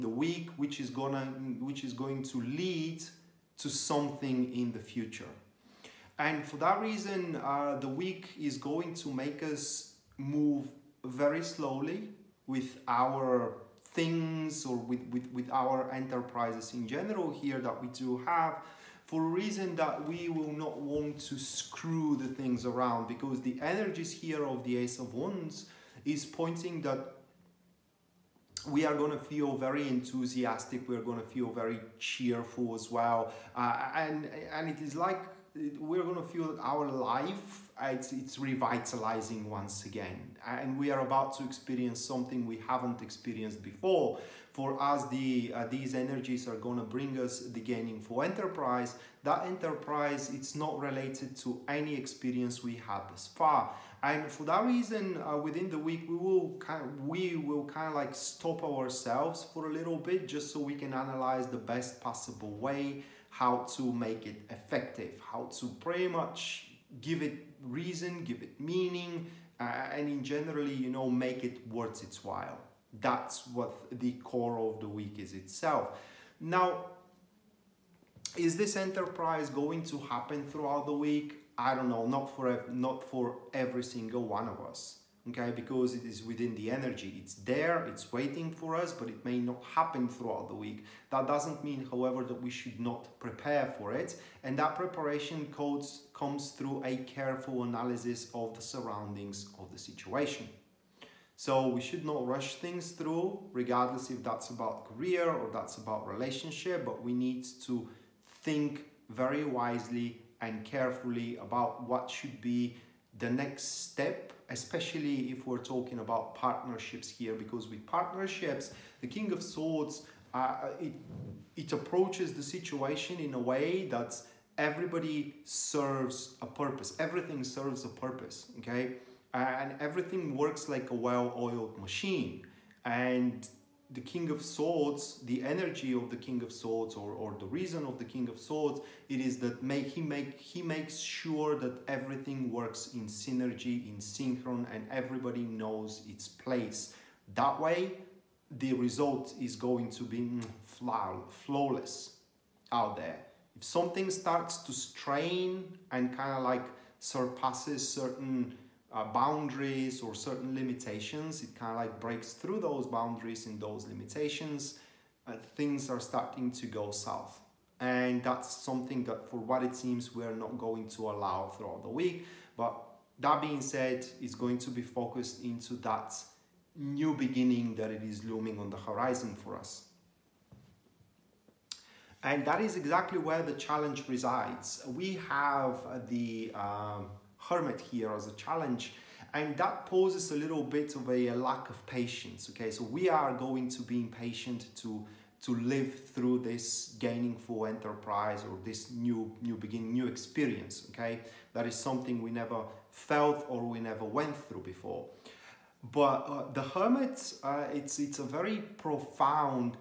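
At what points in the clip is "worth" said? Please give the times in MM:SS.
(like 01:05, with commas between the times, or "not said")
01:11.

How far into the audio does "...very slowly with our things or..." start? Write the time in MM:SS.
00:11.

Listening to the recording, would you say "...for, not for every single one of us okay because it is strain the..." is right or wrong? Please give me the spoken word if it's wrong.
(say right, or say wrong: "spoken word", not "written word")
wrong: "within", not "strain".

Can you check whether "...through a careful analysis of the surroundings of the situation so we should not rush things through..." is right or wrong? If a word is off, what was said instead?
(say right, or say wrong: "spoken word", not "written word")
right.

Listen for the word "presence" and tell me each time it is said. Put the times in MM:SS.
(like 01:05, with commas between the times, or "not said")
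not said.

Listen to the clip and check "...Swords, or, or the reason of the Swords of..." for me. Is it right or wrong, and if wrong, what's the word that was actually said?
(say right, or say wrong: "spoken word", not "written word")
wrong: "King", not "Swords".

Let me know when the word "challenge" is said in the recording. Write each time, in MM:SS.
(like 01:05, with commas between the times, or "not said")
03:03, 03:08.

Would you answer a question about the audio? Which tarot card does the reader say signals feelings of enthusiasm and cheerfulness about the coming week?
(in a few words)
Ace of Wands.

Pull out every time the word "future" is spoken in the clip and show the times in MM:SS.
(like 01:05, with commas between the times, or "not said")
00:04.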